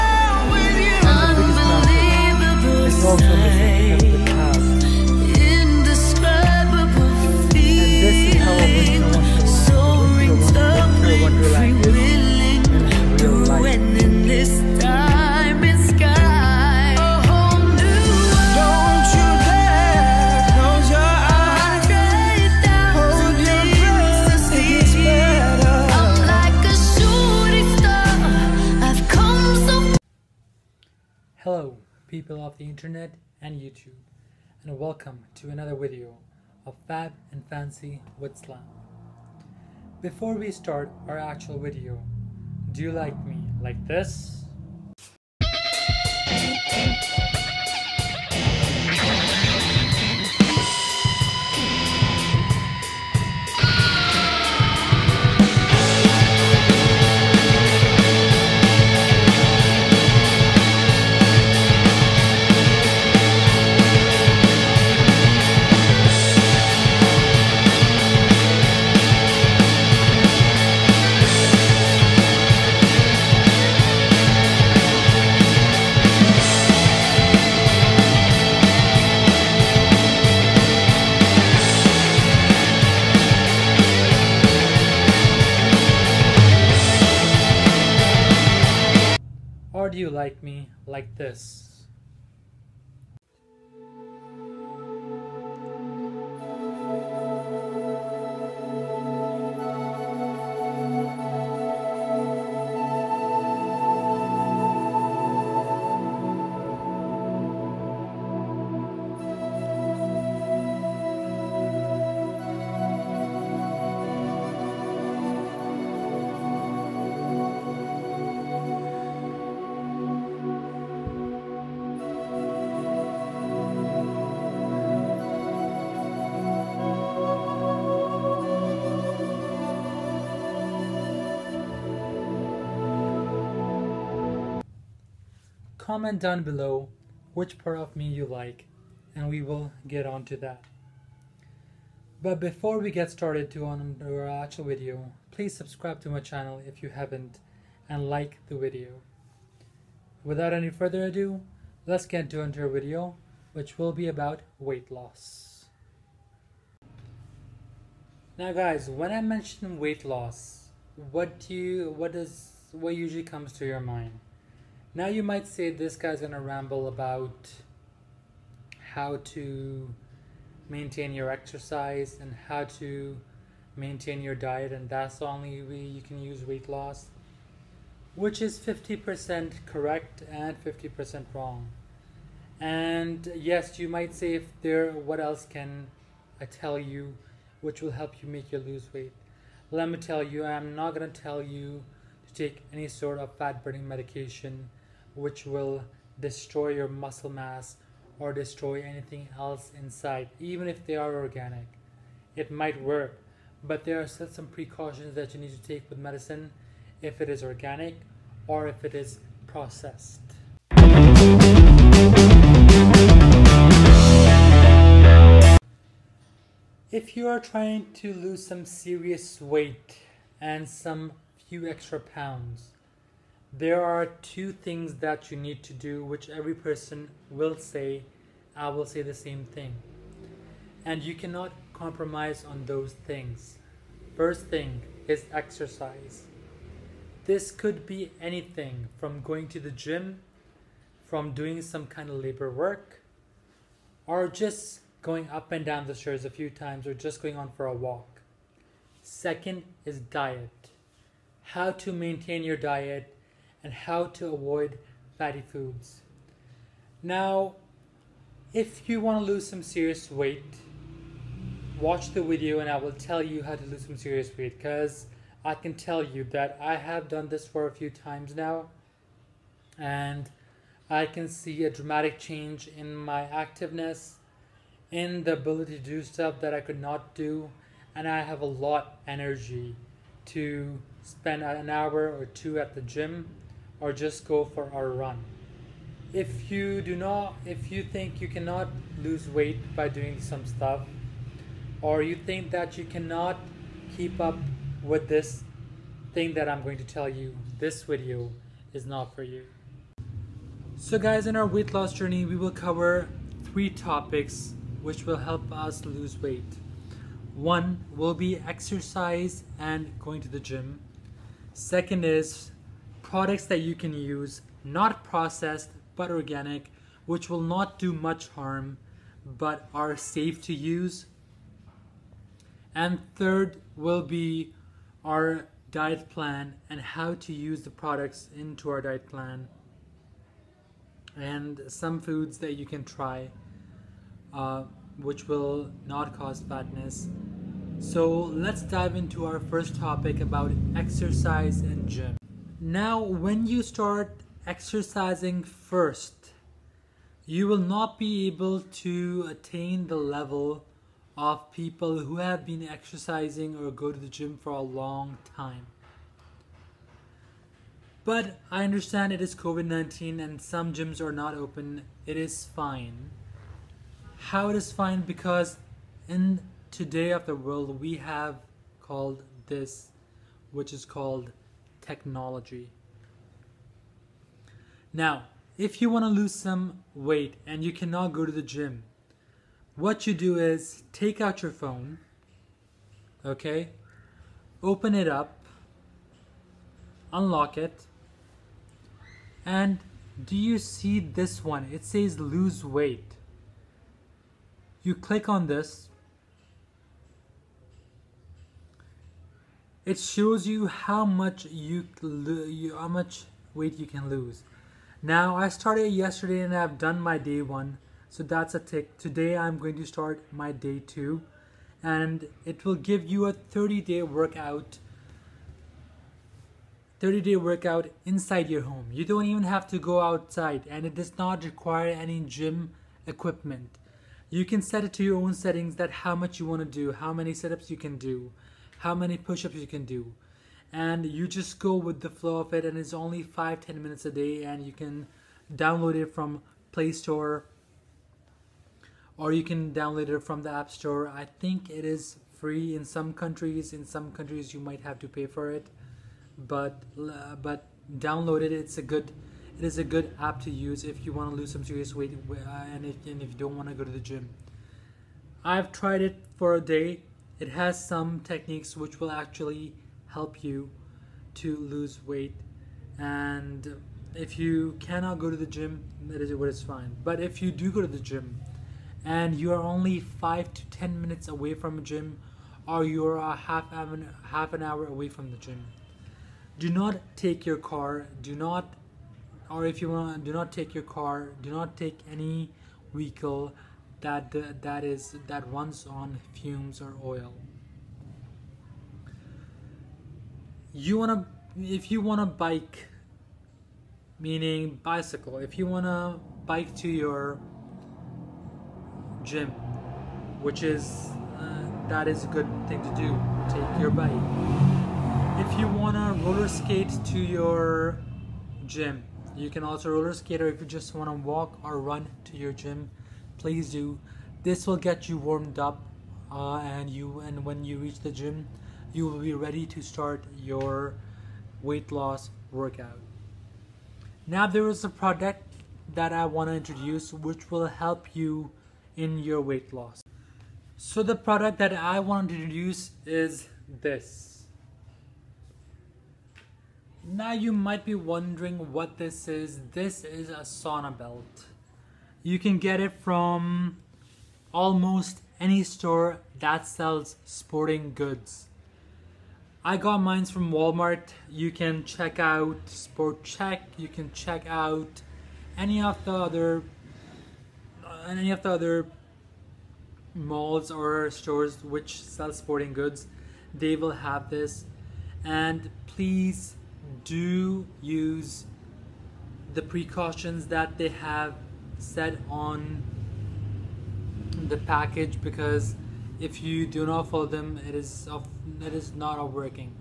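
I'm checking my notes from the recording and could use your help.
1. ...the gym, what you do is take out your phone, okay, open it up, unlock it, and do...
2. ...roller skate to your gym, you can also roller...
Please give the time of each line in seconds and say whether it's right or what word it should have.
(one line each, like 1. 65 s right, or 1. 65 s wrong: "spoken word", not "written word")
1. 378 s right
2. 506 s right.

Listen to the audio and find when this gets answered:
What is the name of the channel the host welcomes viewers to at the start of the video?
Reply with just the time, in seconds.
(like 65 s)
36 s.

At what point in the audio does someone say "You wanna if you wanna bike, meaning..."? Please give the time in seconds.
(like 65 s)
490 s.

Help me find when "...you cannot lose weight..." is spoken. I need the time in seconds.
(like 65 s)
288 s.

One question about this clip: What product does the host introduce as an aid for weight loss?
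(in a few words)
sauna belt.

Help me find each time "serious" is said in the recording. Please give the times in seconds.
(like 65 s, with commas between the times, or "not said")
218 s, 259 s, 263 s, 451 s.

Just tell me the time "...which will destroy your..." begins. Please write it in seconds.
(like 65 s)
195 s.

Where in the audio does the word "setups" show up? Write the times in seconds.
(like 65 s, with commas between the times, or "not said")
427 s.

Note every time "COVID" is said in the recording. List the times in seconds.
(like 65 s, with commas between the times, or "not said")
359 s.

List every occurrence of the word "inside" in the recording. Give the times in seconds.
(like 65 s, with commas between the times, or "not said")
199 s, 418 s.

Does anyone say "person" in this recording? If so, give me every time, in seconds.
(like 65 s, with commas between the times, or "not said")
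226 s.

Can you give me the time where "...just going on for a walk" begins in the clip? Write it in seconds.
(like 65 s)
246 s.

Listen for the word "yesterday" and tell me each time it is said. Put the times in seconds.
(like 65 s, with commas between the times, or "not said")
405 s.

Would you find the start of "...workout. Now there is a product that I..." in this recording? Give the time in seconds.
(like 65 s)
522 s.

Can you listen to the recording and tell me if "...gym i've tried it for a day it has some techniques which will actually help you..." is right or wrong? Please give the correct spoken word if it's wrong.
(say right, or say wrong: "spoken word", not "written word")
right.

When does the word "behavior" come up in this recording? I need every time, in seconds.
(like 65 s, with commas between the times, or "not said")
not said.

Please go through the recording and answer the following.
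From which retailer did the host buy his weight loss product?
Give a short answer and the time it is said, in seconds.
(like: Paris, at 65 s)
Walmart, at 550 s.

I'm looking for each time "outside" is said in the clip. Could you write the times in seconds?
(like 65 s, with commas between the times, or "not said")
419 s.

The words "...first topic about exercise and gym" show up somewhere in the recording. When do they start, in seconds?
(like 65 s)
339 s.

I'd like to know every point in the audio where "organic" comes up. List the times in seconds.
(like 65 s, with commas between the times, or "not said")
201 s, 207 s, 316 s.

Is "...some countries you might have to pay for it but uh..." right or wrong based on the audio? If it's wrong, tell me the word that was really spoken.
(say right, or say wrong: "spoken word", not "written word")
right.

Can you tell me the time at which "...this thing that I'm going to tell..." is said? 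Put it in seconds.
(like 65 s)
295 s.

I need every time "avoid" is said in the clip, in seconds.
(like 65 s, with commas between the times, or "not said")
254 s.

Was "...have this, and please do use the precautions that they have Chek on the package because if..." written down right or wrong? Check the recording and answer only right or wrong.
wrong.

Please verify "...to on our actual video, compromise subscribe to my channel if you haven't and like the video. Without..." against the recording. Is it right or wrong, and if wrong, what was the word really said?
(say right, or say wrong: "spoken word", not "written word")
wrong: "please", not "compromise".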